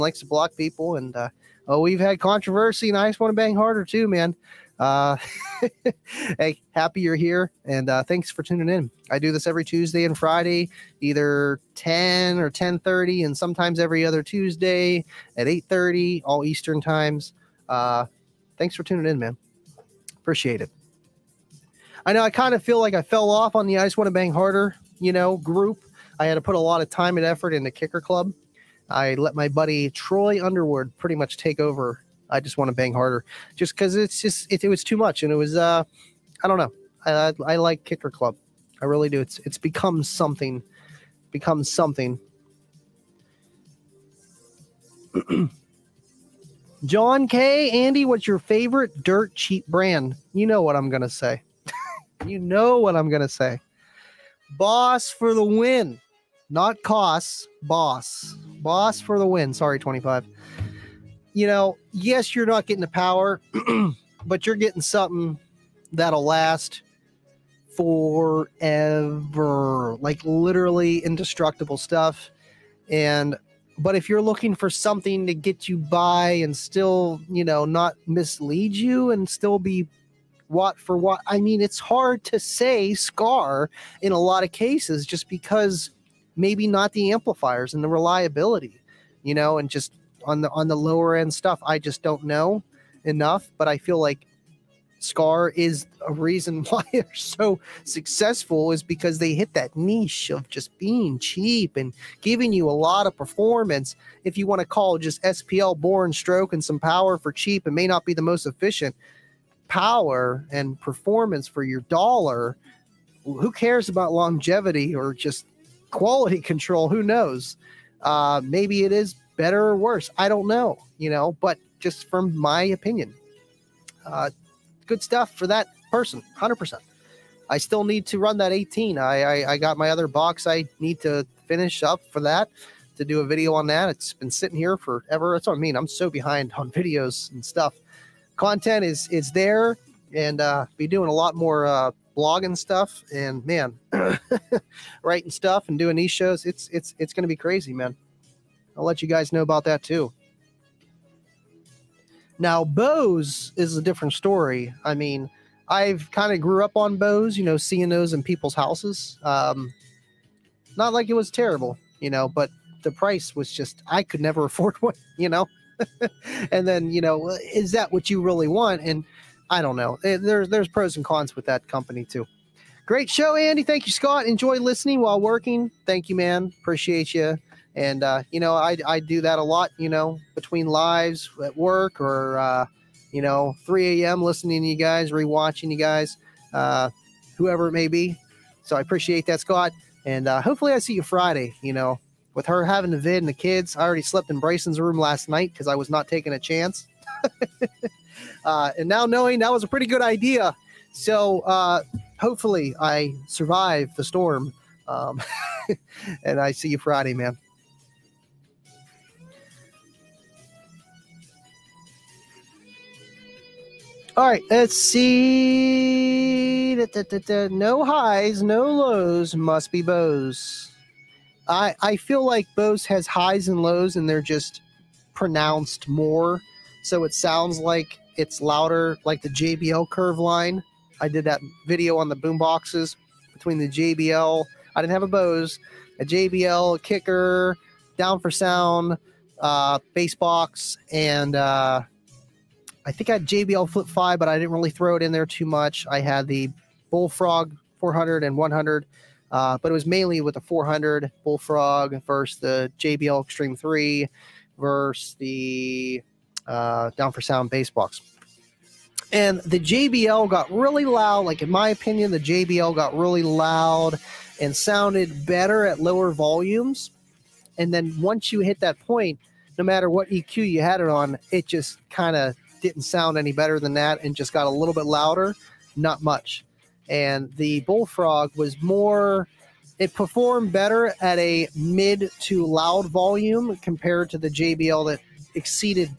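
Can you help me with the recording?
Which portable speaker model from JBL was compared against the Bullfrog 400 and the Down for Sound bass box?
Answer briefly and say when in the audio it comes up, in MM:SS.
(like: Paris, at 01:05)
JBL Xtreme 3, at 04:12.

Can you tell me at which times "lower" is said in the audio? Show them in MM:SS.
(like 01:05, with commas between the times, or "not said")
01:30, 04:25.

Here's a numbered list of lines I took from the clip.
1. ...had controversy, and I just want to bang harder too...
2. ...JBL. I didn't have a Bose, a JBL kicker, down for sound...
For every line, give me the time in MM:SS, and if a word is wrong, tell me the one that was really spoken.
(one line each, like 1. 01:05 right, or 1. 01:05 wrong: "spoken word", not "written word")
1. 00:01 right
2. 03:53 right.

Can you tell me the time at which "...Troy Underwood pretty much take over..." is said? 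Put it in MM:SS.
00:29.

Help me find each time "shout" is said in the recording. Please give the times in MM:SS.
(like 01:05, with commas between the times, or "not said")
not said.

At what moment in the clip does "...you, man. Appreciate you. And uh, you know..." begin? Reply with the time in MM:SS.
02:56.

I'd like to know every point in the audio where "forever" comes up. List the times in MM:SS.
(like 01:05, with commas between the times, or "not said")
01:07, 02:14.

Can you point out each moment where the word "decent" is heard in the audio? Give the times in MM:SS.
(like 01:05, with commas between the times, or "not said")
not said.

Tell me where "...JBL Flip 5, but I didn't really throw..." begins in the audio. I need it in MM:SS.
04:03.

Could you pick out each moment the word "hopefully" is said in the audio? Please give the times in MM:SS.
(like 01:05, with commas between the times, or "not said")
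03:10, 03:22.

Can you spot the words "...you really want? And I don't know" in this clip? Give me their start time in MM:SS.
02:48.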